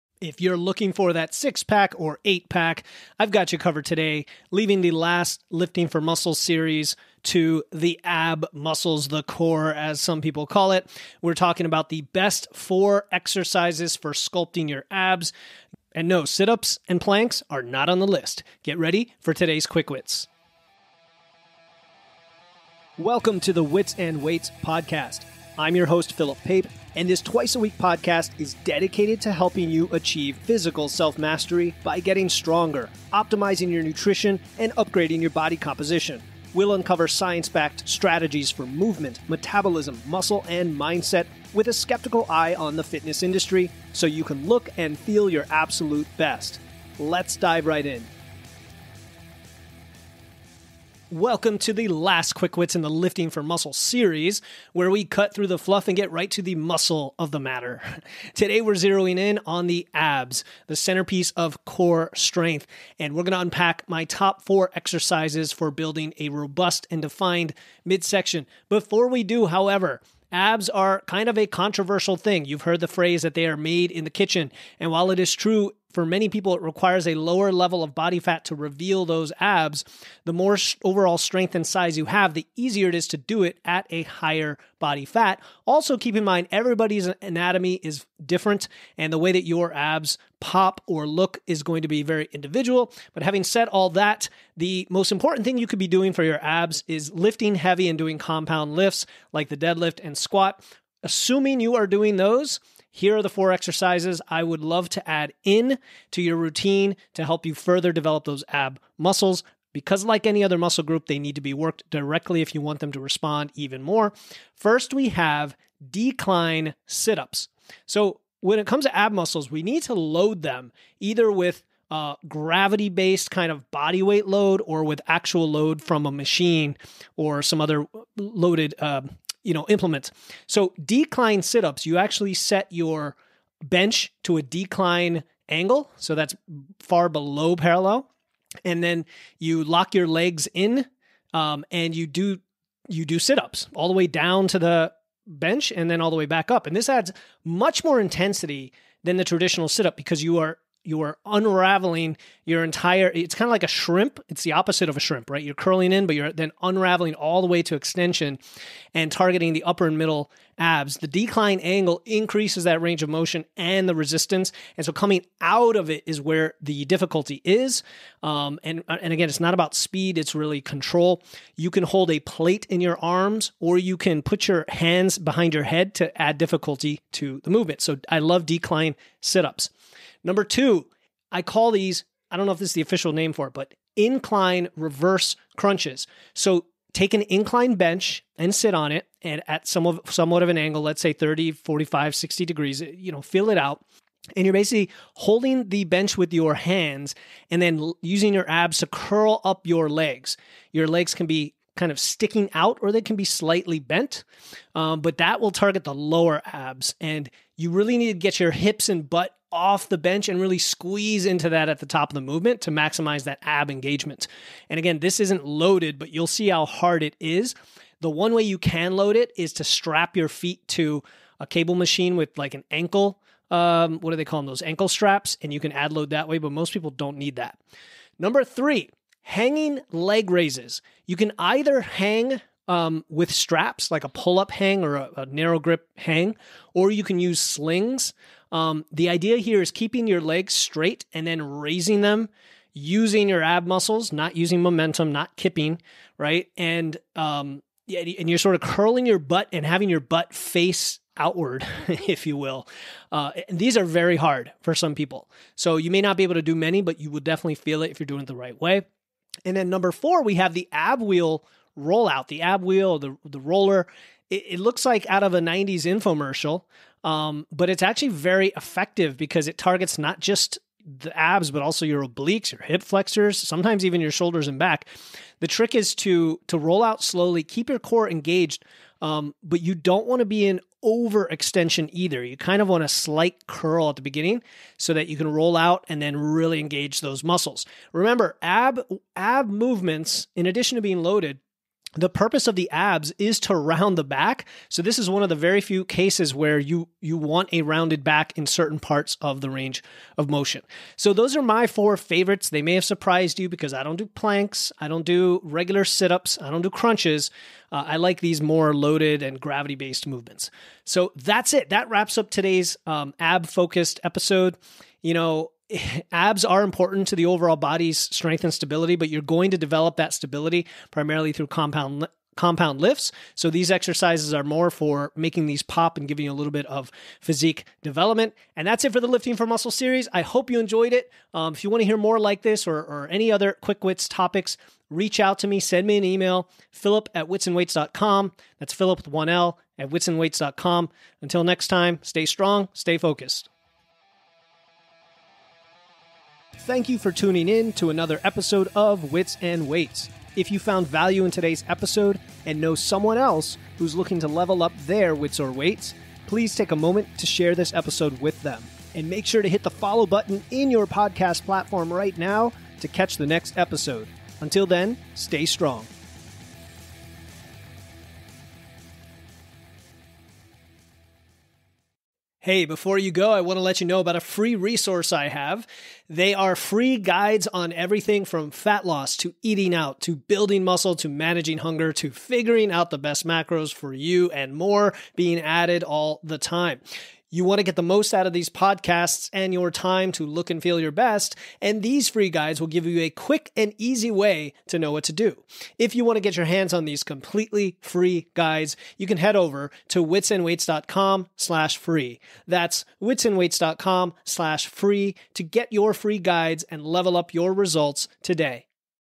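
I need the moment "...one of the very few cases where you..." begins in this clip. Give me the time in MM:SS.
04:55.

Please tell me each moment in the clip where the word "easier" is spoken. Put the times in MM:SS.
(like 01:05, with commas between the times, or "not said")
01:22.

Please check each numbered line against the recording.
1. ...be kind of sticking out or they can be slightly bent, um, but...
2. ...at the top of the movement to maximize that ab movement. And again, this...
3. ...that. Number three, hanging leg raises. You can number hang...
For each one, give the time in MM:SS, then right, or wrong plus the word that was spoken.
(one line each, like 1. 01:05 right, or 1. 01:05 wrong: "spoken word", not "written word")
1. 03:21 right
2. 03:31 wrong: "engagement", not "movement"
3. 03:47 wrong: "either", not "number".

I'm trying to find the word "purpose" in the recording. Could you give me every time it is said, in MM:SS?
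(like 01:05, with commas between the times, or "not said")
04:52.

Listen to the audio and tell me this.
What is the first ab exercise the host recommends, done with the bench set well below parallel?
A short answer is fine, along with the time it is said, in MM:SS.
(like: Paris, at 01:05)
decline sit ups, at 01:55.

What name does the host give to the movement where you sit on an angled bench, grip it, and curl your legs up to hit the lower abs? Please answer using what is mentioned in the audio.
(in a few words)
incline reverse crunches.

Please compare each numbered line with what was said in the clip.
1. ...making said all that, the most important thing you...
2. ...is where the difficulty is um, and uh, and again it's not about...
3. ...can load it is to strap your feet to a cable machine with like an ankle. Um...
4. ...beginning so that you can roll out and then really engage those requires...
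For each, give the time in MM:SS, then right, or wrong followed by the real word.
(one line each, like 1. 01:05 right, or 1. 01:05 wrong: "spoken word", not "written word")
1. 01:33 wrong: "having", not "making"
2. 02:46 right
3. 03:38 right
4. 04:44 wrong: "muscles", not "requires".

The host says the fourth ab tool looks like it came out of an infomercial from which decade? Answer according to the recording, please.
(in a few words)
90s.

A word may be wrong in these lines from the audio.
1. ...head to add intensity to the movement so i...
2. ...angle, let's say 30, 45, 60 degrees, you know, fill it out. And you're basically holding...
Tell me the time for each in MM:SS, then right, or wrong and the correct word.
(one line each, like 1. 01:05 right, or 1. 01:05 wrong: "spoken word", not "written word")
1. 02:55 wrong: "difficulty", not "intensity"
2. 03:10 right.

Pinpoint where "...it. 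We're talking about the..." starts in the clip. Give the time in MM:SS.
00:10.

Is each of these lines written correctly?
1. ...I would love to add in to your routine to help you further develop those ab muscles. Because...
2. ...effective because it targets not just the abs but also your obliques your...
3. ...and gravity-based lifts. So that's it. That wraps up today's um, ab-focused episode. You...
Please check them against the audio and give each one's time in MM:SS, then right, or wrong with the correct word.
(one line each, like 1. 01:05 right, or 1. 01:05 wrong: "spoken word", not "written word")
1. 01:44 right
2. 04:28 right
3. 05:09 wrong: "movements", not "lifts".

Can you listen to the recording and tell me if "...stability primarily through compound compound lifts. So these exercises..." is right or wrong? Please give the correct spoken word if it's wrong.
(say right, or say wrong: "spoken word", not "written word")
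right.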